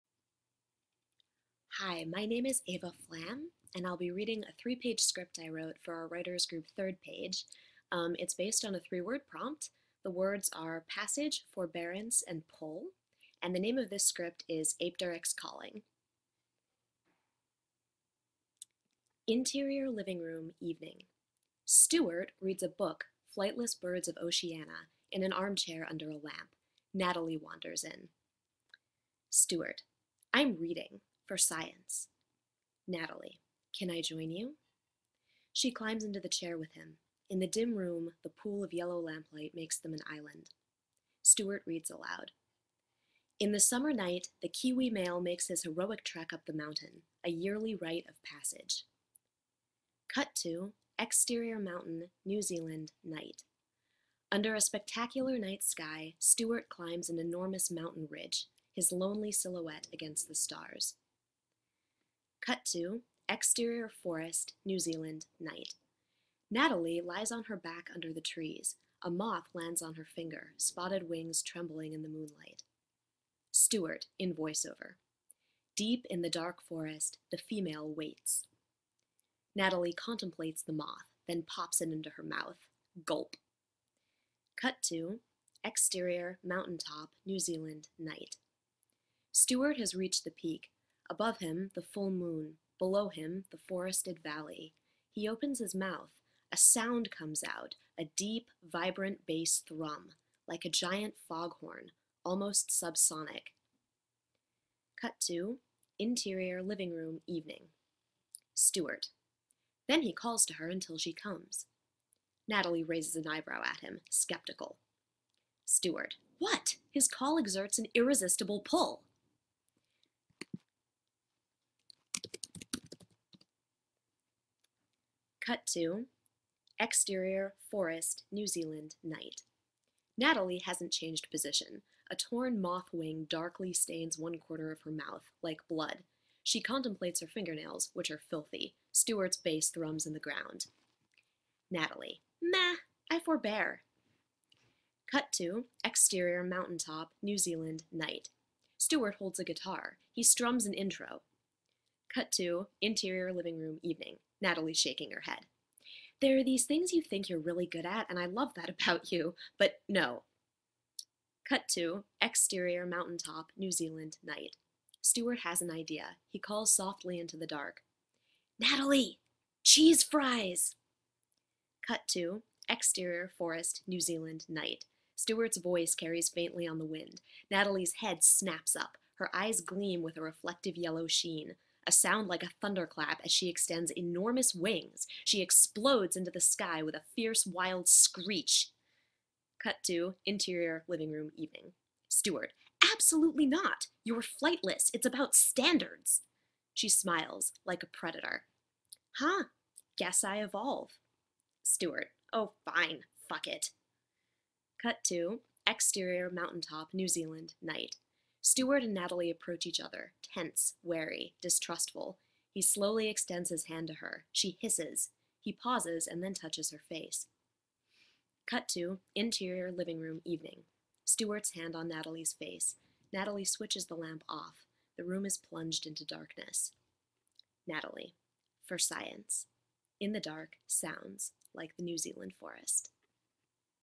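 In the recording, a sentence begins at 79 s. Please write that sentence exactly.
Natalie contemplates the moth, then pops it into her mouth.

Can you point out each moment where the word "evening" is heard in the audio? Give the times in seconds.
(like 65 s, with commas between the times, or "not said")
20 s, 107 s, 153 s, 191 s, 220 s.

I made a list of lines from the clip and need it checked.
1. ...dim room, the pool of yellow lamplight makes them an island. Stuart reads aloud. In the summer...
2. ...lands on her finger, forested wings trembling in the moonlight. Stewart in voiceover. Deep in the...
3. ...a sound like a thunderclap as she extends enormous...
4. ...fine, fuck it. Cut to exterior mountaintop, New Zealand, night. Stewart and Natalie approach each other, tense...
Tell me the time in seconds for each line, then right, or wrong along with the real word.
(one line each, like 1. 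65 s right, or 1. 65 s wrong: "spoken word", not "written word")
1. 37 s right
2. 69 s wrong: "spotted", not "forested"
3. 181 s right
4. 202 s right.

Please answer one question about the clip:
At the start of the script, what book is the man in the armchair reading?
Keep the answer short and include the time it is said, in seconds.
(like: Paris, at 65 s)
Flightless Birds of Oceania, at 23 s.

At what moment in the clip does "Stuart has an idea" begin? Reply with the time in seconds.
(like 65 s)
165 s.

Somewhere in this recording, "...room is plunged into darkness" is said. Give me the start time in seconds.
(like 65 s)
225 s.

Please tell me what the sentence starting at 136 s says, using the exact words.
She contemplates her fingernails, which are filthy.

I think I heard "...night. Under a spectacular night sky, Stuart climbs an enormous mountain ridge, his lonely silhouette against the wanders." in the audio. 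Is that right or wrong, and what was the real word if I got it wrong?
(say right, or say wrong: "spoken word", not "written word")
wrong: "stars", not "wanders".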